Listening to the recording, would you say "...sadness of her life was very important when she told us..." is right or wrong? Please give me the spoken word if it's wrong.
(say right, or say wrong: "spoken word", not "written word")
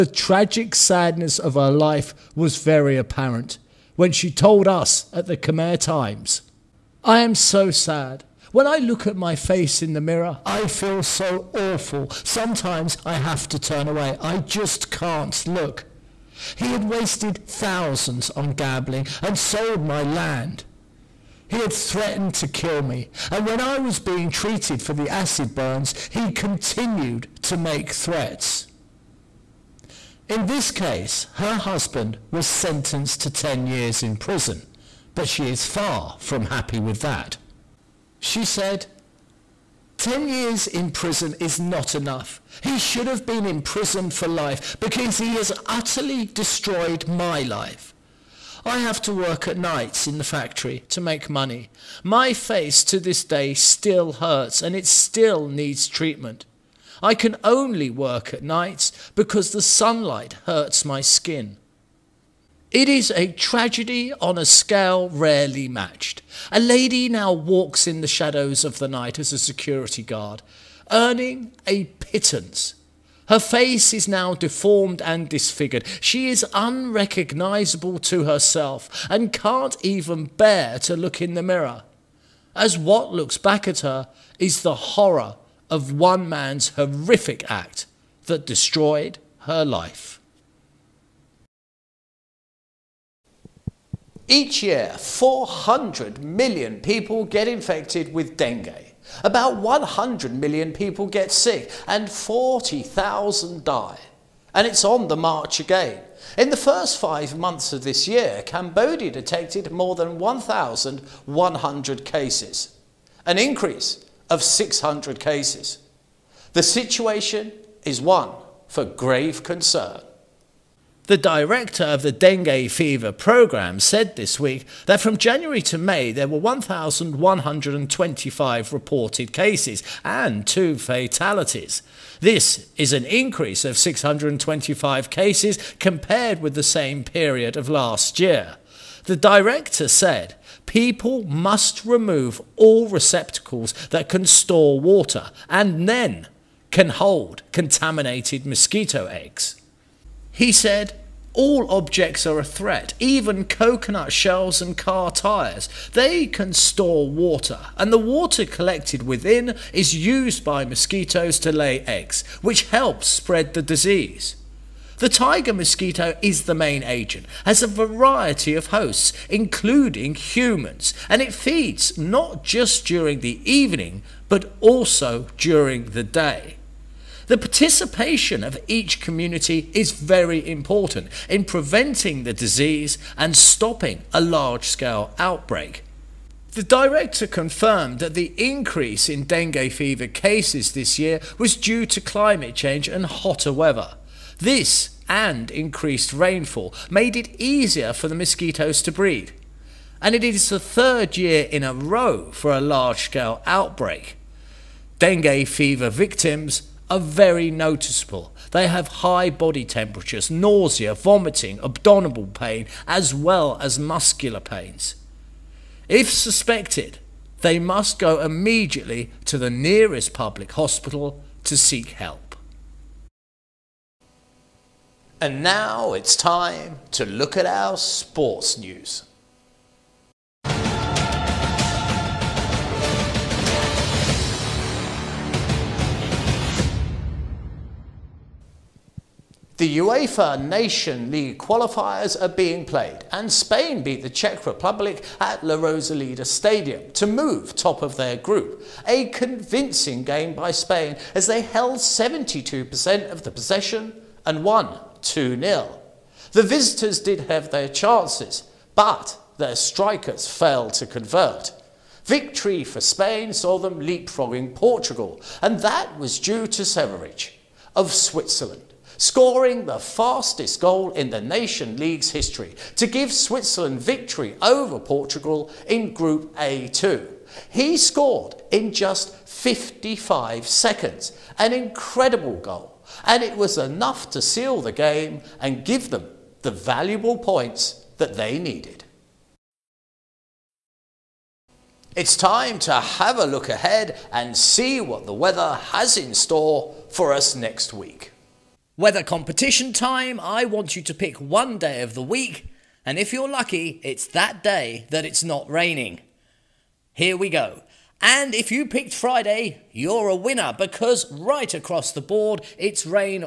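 wrong: "apparent", not "important".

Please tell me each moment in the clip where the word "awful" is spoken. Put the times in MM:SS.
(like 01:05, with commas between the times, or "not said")
00:11.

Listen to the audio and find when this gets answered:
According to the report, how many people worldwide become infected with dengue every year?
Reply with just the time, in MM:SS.
01:34.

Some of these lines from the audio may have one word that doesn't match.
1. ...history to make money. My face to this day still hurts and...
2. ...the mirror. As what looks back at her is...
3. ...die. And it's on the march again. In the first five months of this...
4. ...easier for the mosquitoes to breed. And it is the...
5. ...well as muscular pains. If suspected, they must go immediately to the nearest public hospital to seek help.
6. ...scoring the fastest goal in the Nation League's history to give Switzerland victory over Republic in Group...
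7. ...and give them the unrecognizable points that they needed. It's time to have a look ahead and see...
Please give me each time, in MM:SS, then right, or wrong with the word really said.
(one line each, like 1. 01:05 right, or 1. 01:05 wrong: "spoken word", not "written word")
1. 00:50 wrong: "factory", not "history"
2. 01:21 right
3. 01:43 right
4. 03:17 right
5. 03:33 right
6. 04:28 wrong: "Portugal", not "Republic"
7. 04:45 wrong: "valuable", not "unrecognizable".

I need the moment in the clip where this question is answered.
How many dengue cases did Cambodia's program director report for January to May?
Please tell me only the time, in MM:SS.
02:06.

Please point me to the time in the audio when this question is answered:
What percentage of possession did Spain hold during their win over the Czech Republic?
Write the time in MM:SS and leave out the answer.
04:11.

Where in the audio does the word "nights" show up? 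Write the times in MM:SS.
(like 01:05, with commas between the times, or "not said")
00:49, 00:58, 01:08.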